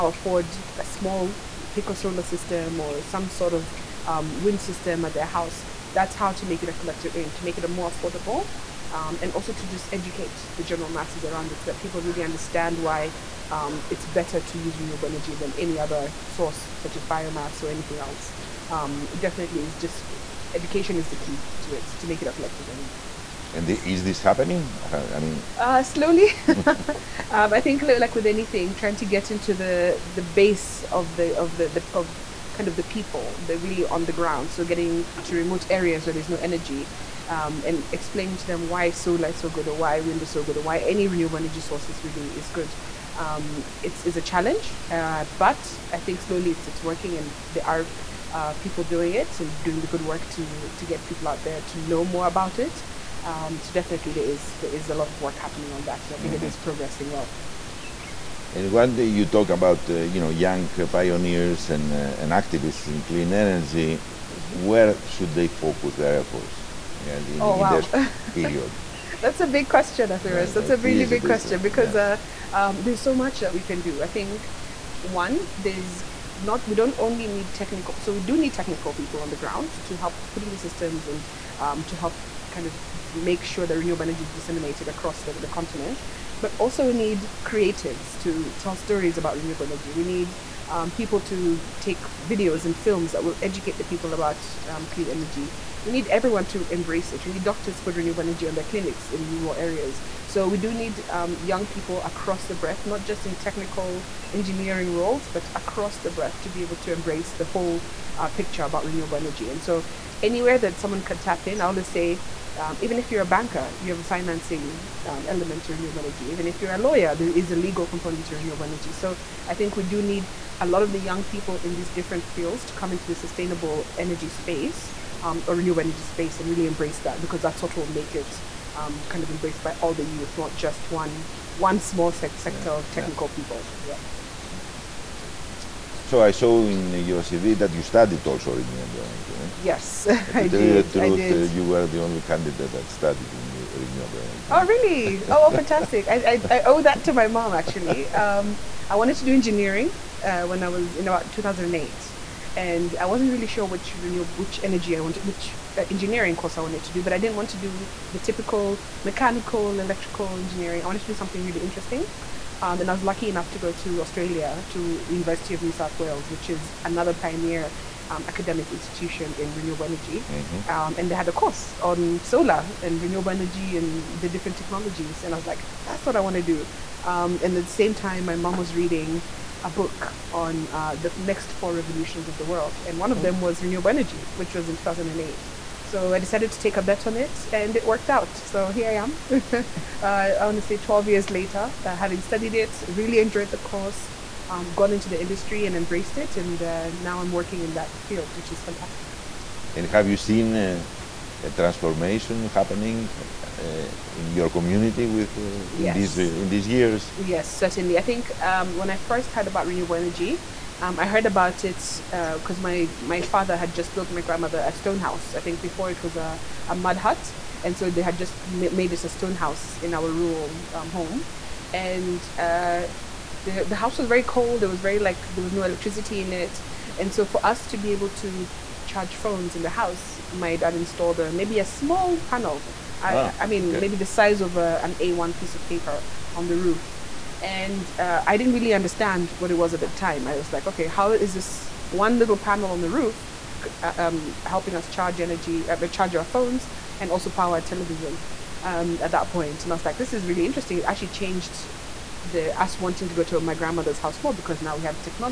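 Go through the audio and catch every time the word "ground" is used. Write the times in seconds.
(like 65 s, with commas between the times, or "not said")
34 s, 79 s.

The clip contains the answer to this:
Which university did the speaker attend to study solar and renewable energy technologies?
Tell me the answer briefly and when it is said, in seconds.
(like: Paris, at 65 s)
University of New South Wales, at 165 s.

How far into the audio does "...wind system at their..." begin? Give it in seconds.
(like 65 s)
4 s.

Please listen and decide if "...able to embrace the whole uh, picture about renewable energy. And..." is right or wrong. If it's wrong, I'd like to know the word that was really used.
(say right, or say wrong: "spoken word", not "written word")
right.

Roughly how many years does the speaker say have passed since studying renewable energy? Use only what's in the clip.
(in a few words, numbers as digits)
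12.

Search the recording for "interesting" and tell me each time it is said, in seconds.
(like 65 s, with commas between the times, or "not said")
161 s, 250 s.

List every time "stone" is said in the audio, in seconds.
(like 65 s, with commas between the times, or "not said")
214 s, 219 s.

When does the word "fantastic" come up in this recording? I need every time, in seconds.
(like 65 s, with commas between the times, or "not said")
145 s, 198 s.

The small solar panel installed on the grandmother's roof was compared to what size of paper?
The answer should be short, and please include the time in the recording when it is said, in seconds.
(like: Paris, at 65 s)
A1, at 234 s.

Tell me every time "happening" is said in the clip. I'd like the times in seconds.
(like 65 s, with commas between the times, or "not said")
24 s, 55 s, 202 s.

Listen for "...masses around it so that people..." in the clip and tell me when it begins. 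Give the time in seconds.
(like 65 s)
10 s.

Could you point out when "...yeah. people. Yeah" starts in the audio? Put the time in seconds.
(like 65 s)
133 s.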